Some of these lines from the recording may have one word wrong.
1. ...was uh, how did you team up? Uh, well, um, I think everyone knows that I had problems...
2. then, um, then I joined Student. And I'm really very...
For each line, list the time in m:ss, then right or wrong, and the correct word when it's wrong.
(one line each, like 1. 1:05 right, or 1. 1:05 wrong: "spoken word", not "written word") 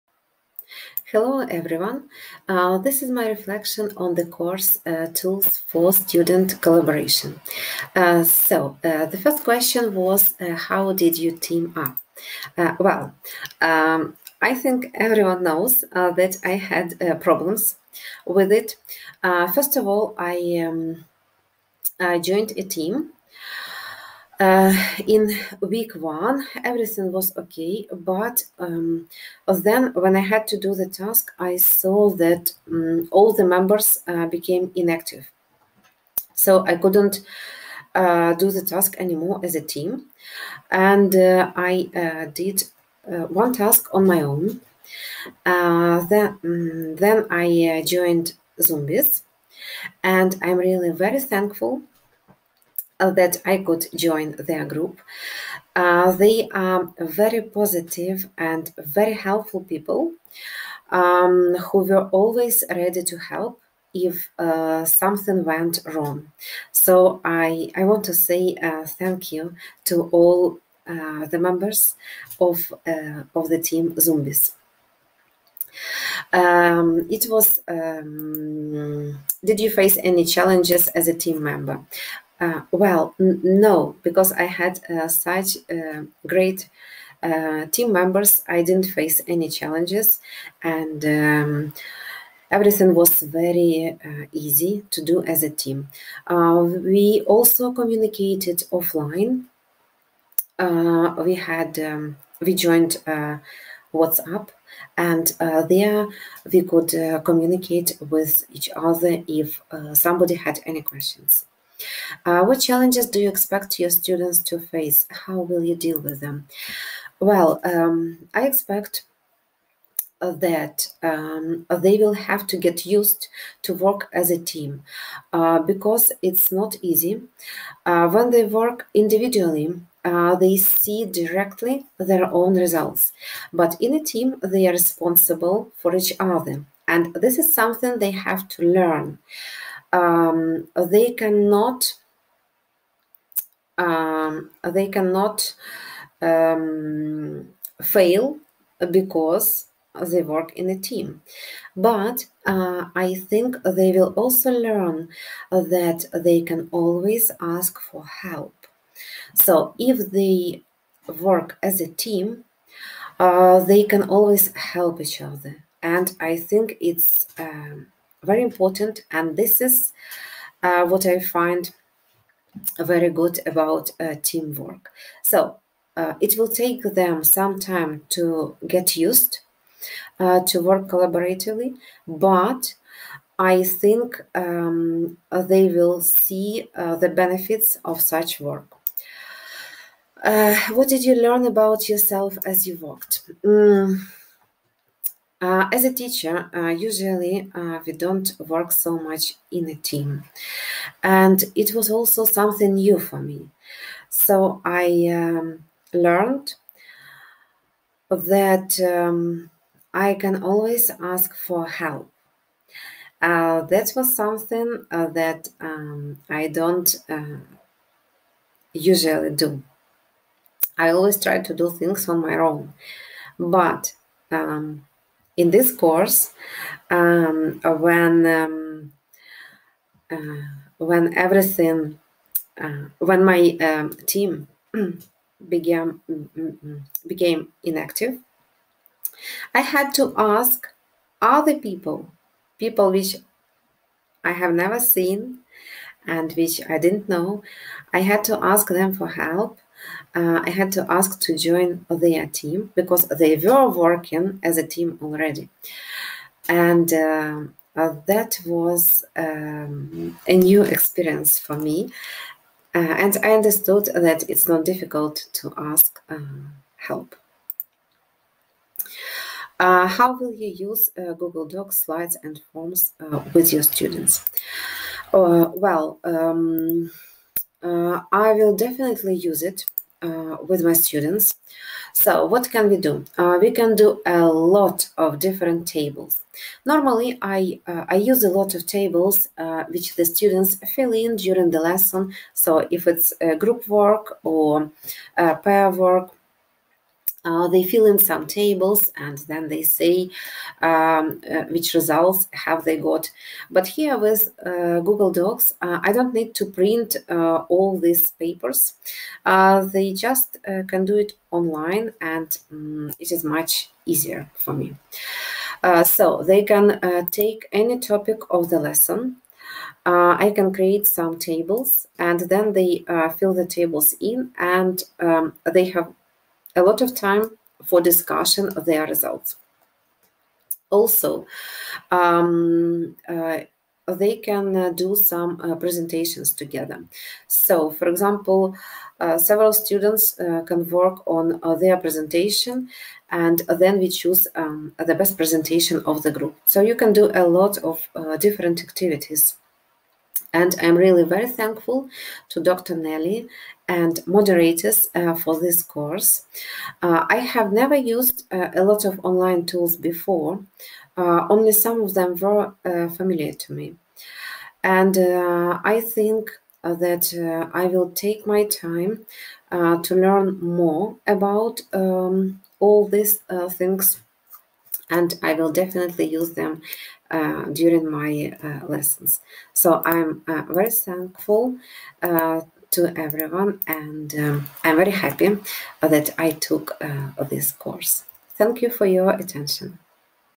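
1. 0:09 right
2. 0:45 wrong: "Zombies", not "Student".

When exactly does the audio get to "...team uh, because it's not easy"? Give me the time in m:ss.
2:04.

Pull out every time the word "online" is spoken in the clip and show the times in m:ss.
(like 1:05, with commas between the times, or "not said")
5:11, 5:59.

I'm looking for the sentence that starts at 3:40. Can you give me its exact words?
I always try to do things on my own.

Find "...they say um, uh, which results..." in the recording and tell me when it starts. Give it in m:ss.
4:59.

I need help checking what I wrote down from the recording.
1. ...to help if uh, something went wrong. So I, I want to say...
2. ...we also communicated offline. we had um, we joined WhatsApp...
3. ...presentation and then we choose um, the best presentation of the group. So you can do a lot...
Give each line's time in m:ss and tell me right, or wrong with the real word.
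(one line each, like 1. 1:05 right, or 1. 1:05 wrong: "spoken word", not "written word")
1. 1:03 right
2. 1:36 right
3. 5:41 right.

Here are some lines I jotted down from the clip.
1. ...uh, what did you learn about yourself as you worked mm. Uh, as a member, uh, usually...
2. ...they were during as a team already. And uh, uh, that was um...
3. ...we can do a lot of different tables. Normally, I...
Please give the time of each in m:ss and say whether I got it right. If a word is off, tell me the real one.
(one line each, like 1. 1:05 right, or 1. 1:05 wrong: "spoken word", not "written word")
1. 3:10 wrong: "teacher", not "member"
2. 4:13 wrong: "working", not "during"
3. 4:43 right.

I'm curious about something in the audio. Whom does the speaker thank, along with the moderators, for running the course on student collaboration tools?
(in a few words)
Dr. Nelly.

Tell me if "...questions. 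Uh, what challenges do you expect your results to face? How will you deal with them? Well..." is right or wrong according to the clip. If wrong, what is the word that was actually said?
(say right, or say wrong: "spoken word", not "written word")
wrong: "students", not "results".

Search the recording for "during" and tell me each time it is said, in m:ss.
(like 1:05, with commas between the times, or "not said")
4:51, 6:17.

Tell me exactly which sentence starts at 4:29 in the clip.
Uh, how will you use Google Docs, slides, and forms with your students?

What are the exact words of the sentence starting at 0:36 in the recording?
So I couldn't uh, do the task anymore as a team.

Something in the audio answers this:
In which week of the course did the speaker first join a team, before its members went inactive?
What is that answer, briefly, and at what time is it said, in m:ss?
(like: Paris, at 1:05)
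week one, at 0:25.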